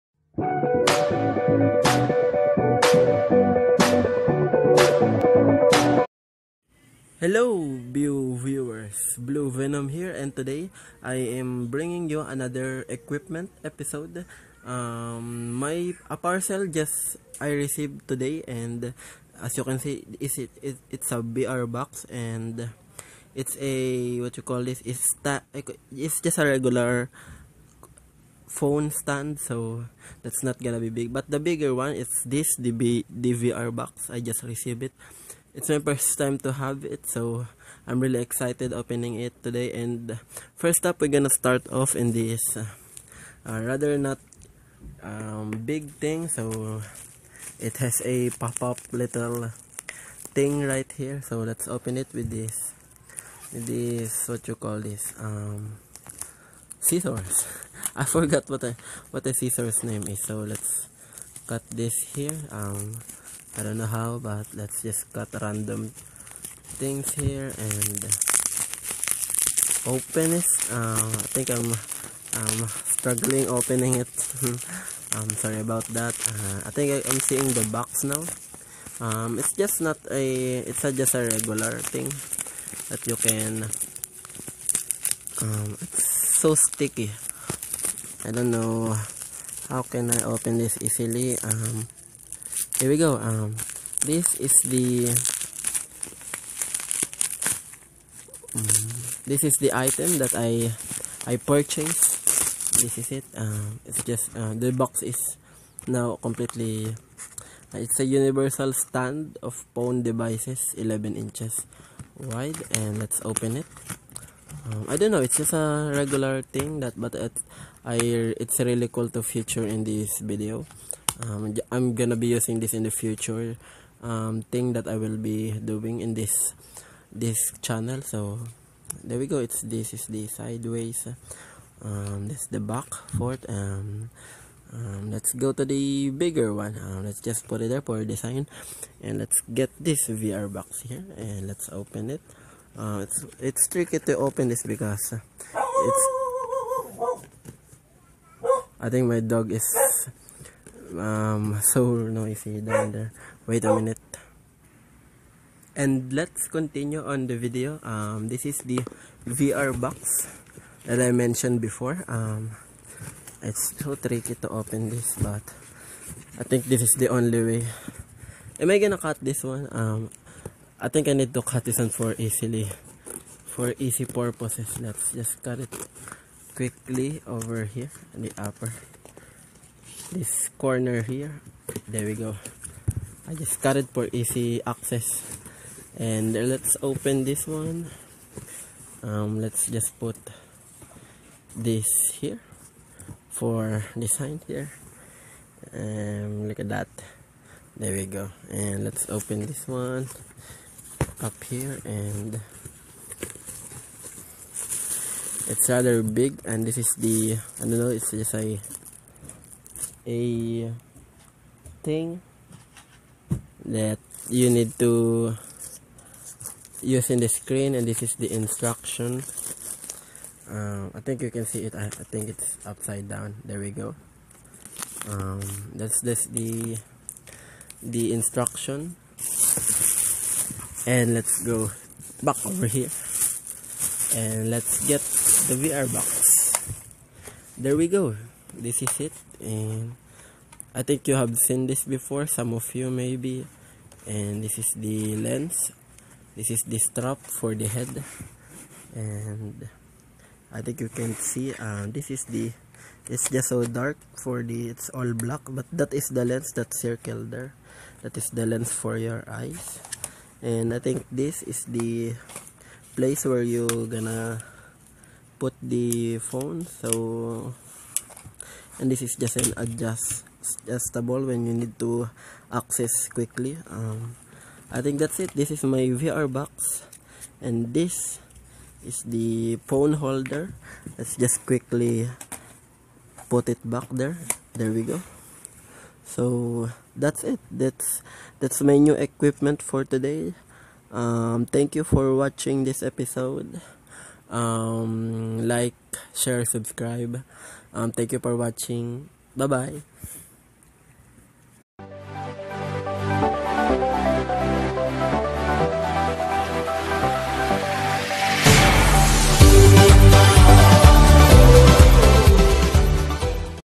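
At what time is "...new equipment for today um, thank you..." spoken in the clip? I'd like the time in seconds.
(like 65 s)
288 s.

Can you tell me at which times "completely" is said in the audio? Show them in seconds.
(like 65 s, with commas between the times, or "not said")
106 s.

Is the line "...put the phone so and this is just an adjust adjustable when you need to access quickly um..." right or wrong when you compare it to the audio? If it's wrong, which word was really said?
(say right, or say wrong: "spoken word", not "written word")
right.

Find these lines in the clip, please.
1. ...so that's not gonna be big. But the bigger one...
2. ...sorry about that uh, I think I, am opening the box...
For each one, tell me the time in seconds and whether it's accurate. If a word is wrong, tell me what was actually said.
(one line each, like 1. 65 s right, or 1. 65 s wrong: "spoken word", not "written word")
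1. 29 s right
2. 75 s wrong: "seeing", not "opening".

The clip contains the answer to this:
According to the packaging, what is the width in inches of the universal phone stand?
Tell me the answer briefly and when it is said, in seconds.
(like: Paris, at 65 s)
11, at 110 s.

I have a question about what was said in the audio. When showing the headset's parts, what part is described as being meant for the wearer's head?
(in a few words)
strap.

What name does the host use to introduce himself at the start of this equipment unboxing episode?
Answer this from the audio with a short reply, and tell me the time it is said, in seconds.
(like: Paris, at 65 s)
Blue Venom, at 9 s.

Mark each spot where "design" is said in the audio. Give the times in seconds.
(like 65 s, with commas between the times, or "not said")
138 s, 193 s.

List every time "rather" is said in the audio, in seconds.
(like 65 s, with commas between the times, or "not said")
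43 s, 205 s.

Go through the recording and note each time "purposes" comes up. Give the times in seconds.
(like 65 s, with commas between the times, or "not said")
174 s.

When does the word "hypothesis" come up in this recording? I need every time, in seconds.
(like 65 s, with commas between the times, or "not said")
not said.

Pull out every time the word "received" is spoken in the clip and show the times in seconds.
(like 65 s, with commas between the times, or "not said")
17 s, 34 s.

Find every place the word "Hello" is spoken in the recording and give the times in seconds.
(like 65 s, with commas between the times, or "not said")
7 s.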